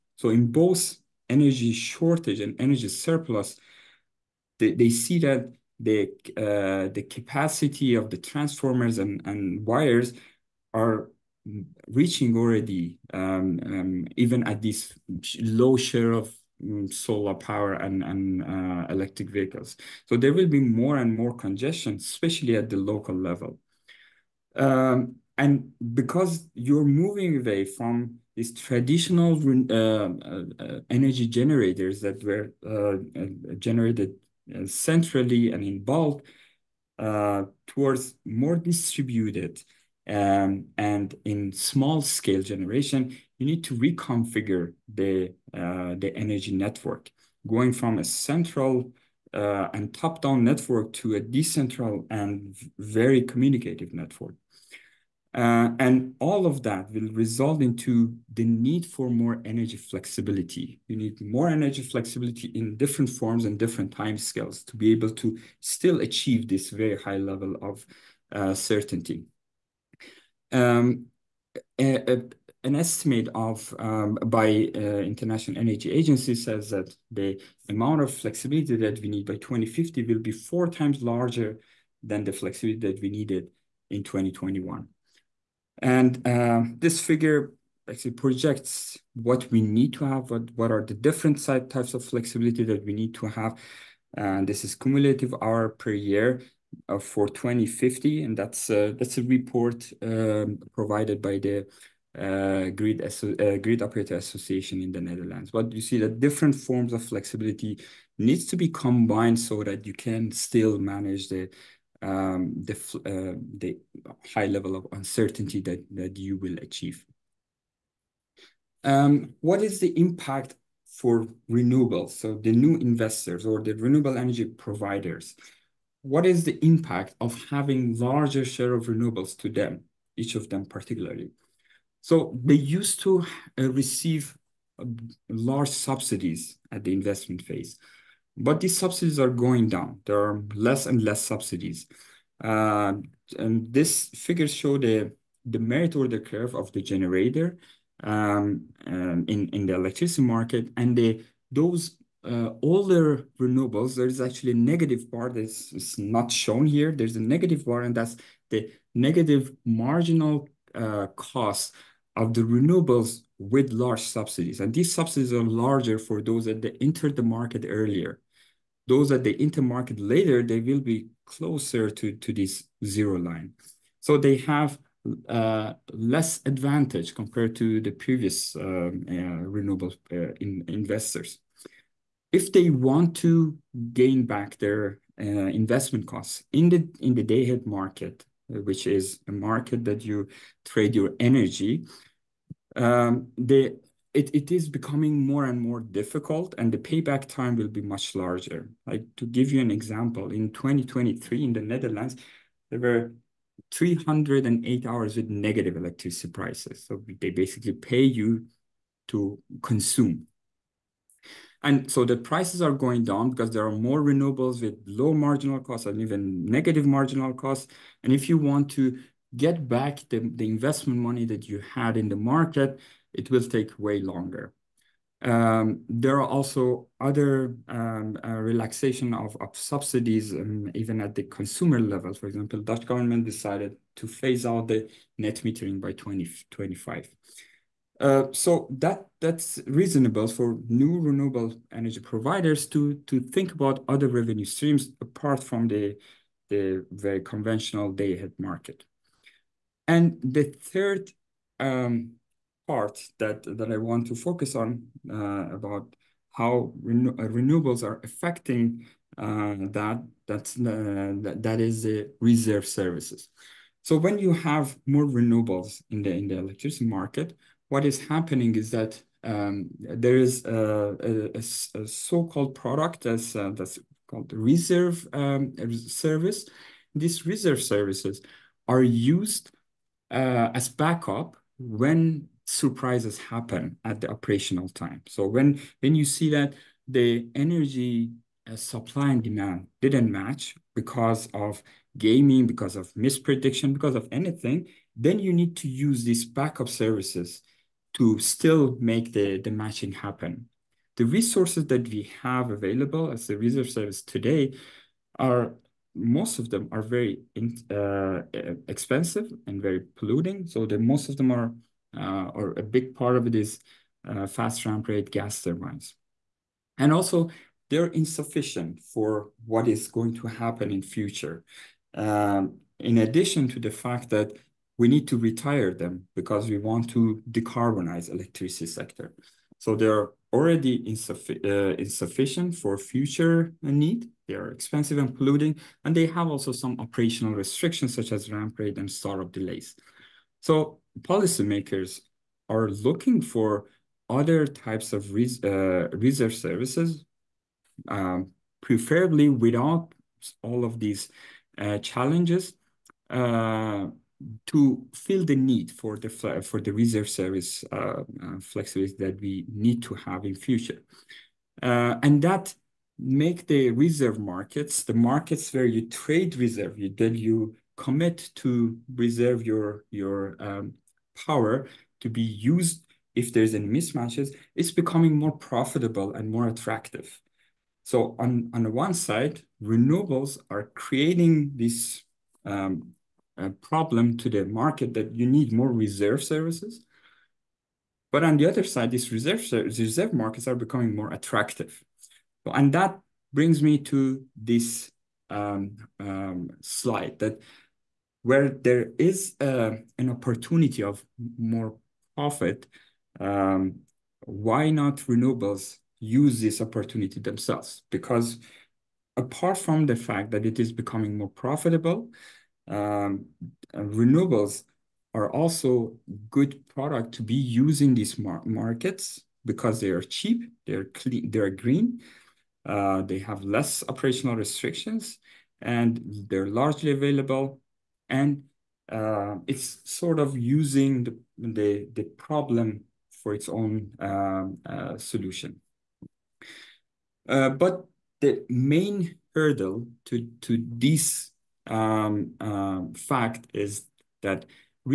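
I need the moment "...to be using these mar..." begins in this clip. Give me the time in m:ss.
6:57.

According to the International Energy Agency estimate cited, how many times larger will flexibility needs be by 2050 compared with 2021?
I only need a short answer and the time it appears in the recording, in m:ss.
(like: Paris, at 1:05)
4 times, at 1:20.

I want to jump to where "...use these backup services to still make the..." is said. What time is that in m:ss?
4:55.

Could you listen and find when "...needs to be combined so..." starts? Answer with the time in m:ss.
1:48.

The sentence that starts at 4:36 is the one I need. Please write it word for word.
These reserve services are used uh, as backup when surprises happen at the operational time.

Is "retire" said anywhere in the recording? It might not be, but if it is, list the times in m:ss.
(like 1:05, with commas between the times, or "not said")
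5:25.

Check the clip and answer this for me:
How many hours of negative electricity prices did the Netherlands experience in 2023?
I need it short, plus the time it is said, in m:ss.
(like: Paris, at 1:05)
308, at 3:23.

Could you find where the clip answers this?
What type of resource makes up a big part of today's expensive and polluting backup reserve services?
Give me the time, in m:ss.
5:14.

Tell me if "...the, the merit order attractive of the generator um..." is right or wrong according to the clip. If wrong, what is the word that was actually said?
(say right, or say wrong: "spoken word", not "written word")
wrong: "curve", not "attractive".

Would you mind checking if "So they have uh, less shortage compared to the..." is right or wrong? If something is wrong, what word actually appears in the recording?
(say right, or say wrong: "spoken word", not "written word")
wrong: "advantage", not "shortage".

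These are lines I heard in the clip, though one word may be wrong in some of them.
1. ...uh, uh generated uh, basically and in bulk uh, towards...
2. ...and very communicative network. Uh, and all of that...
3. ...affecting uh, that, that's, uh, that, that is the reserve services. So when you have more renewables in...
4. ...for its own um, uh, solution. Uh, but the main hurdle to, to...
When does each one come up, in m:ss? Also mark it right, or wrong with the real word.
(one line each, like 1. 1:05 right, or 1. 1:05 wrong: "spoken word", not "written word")
1. 0:32 wrong: "centrally", not "basically"
2. 0:52 right
3. 4:18 right
4. 7:13 right.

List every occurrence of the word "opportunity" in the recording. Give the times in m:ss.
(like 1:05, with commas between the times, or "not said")
6:40, 6:46.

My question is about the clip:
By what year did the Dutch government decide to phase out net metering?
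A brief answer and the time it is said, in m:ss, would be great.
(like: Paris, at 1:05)
2025, at 3:55.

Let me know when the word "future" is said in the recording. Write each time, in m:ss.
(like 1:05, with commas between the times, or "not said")
5:20, 5:32, 6:00.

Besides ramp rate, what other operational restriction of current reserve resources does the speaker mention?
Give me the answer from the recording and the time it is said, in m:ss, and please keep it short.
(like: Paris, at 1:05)
Startup delays, at 5:38.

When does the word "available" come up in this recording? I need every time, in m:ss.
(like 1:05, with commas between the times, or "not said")
5:02, 7:06.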